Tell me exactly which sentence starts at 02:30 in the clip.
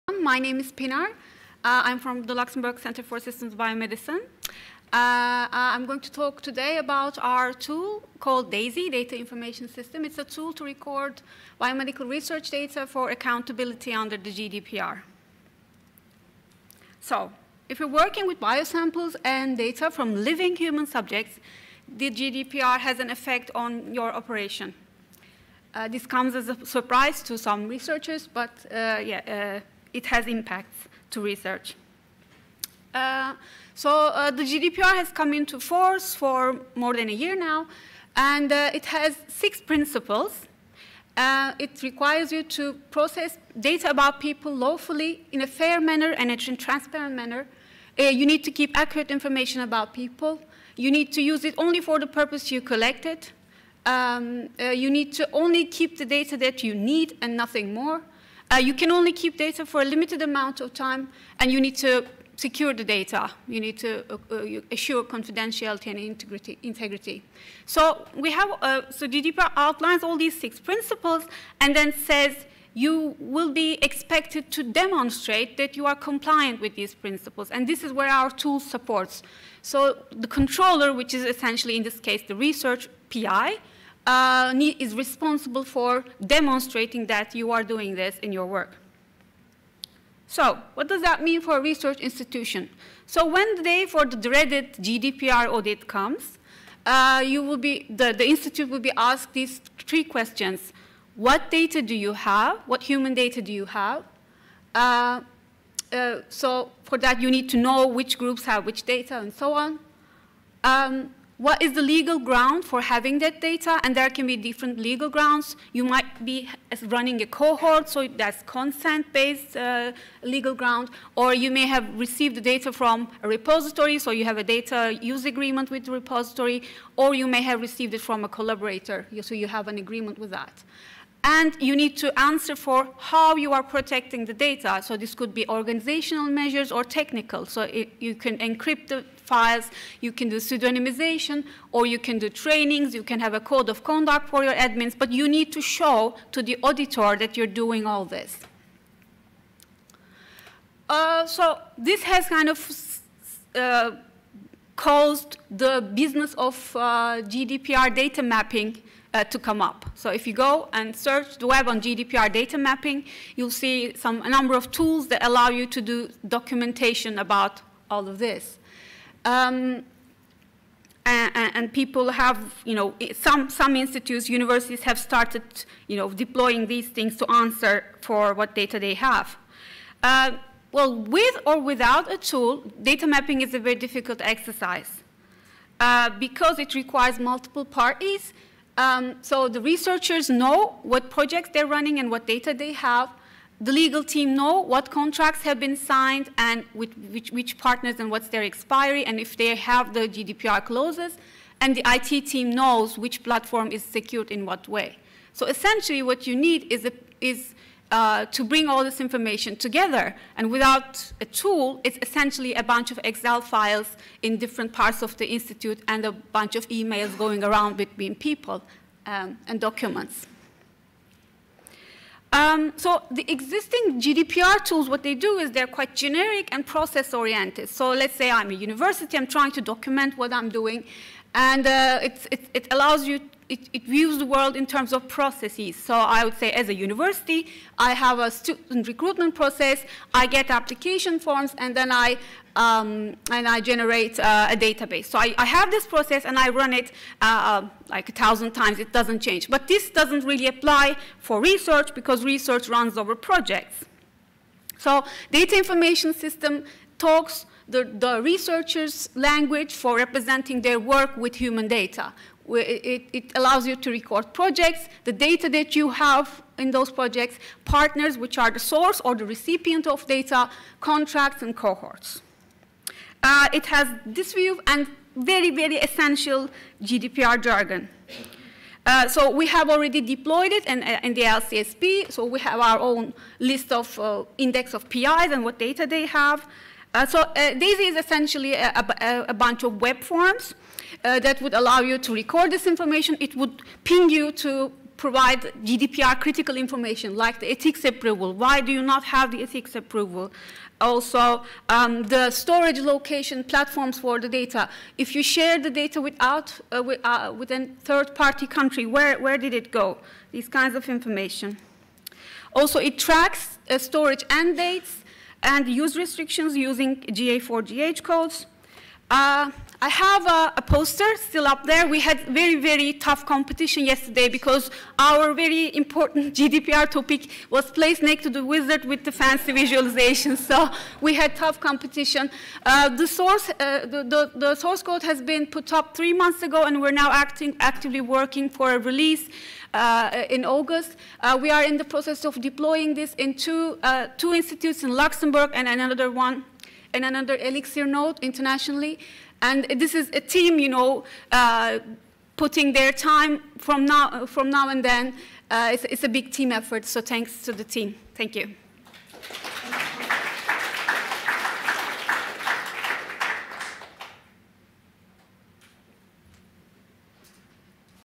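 Uh, so this has kind of uh, caused the business of uh, GDPR data mapping uh, to come up.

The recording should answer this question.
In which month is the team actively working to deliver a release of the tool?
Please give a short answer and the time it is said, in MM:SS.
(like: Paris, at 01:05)
August, at 05:40.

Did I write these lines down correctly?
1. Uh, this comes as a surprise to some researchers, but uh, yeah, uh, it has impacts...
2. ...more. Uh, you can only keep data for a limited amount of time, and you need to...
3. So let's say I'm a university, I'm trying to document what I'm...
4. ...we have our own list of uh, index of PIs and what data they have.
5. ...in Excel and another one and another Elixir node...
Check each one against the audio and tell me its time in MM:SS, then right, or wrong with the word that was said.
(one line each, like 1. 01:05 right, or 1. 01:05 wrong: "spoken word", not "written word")
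1. 00:25 right
2. 00:57 right
3. 03:47 right
4. 04:42 right
5. 05:44 wrong: "Luxembourg", not "Excel".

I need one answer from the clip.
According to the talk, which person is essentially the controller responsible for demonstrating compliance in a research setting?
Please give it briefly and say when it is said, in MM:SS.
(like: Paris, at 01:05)
research PI, at 01:22.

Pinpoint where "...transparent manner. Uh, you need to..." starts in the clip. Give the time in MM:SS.
00:46.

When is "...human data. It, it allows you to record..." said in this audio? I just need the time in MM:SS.
04:21.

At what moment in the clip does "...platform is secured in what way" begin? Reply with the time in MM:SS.
03:23.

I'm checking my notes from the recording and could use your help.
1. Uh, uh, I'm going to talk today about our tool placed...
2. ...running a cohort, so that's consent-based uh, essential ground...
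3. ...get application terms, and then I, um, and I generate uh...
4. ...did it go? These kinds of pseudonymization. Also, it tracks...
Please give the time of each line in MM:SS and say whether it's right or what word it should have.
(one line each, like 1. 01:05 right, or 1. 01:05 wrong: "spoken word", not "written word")
1. 00:04 wrong: "called", not "placed"
2. 01:56 wrong: "legal", not "essential"
3. 04:00 wrong: "forms", not "terms"
4. 05:09 wrong: "information", not "pseudonymization".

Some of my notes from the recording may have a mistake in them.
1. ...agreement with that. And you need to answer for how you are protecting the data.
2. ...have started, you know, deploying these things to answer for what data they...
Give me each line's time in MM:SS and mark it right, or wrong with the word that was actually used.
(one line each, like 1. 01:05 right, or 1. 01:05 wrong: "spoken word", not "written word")
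1. 02:09 right
2. 02:54 right.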